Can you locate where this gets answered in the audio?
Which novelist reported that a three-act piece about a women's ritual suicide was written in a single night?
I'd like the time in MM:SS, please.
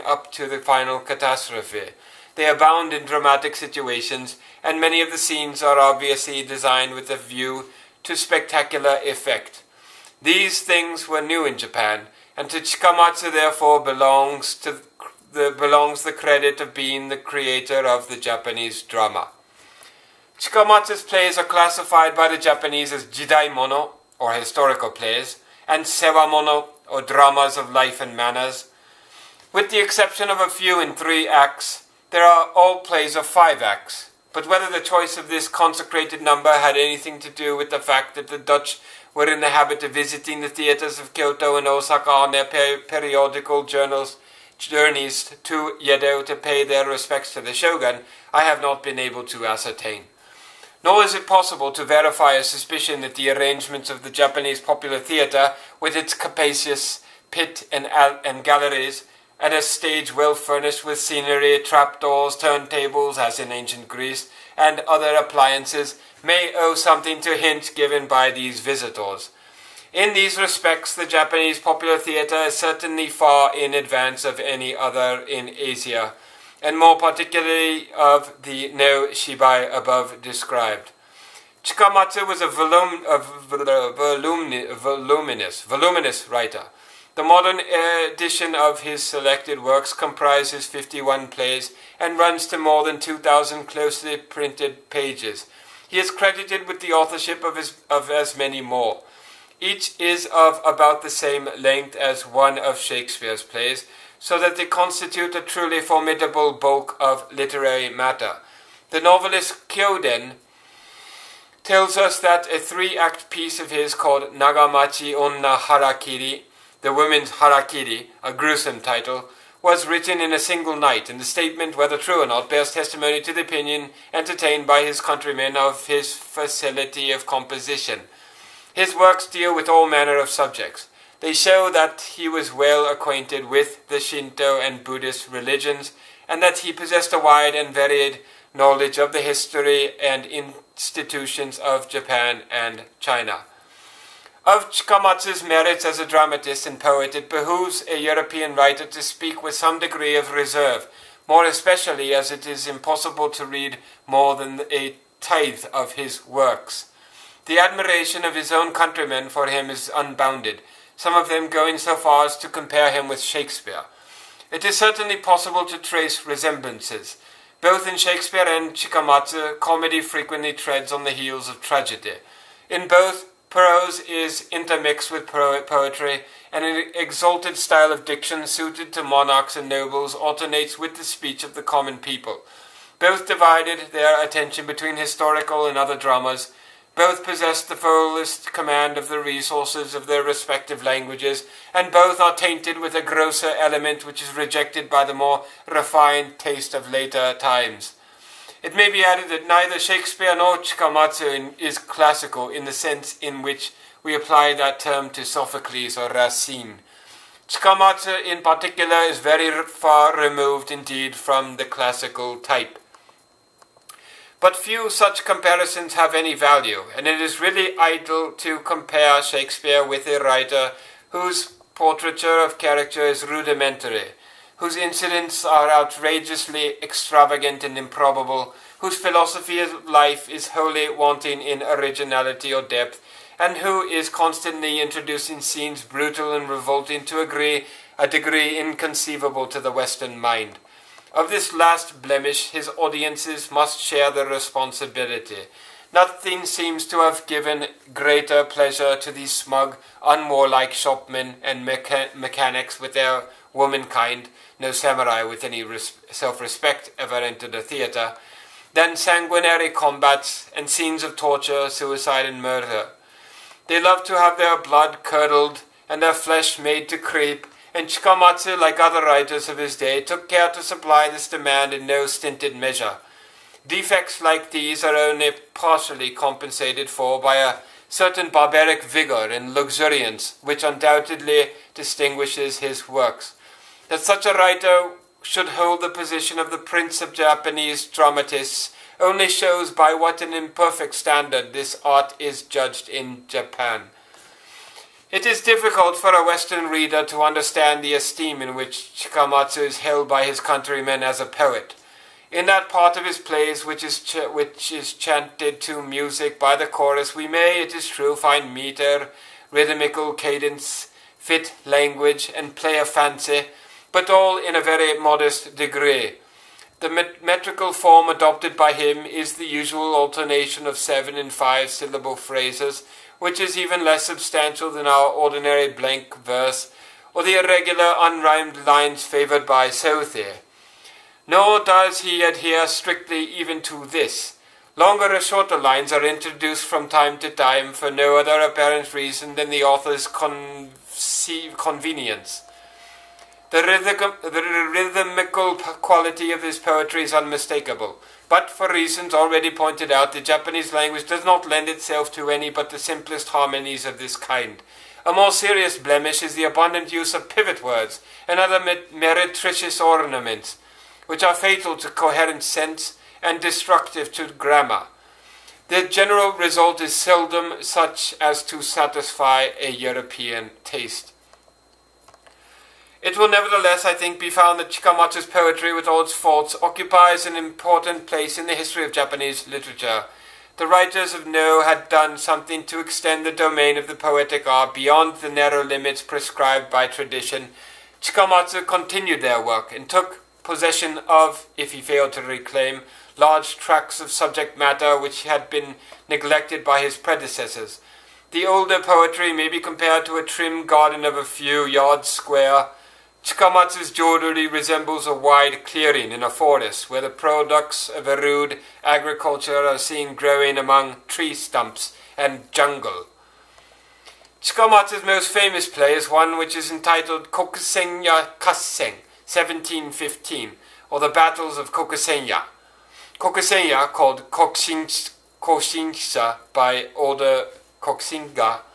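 01:49.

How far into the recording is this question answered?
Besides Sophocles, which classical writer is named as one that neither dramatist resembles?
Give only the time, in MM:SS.
03:26.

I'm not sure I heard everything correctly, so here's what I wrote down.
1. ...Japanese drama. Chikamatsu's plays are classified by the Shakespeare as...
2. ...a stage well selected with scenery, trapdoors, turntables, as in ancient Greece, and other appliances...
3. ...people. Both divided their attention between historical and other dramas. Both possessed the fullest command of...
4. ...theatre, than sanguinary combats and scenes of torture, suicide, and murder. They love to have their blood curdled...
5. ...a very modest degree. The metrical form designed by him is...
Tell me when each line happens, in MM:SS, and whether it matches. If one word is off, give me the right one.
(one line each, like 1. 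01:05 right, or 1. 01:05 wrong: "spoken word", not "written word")
1. 00:18 wrong: "Japanese", not "Shakespeare"
2. 00:59 wrong: "furnished", not "selected"
3. 03:01 right
4. 04:17 right
5. 05:14 wrong: "adopted", not "designed".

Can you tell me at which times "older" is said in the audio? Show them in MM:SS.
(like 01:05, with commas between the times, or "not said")
06:38, 07:06.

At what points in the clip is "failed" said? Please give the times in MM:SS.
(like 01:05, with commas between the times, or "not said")
06:31.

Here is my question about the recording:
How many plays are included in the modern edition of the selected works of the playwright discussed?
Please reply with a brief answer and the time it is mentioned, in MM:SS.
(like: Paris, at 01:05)
51, at 01:30.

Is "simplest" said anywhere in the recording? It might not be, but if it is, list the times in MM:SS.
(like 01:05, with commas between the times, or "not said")
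05:52.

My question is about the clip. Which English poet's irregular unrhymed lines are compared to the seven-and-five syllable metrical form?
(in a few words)
Southey.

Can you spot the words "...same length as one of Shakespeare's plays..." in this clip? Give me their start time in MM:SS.
01:41.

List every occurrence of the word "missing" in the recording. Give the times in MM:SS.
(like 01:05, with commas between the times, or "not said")
not said.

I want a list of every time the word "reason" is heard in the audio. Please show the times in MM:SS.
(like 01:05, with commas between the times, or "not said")
05:38, 05:48.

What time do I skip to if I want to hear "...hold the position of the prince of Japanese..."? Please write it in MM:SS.
04:45.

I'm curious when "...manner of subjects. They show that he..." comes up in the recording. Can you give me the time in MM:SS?
02:09.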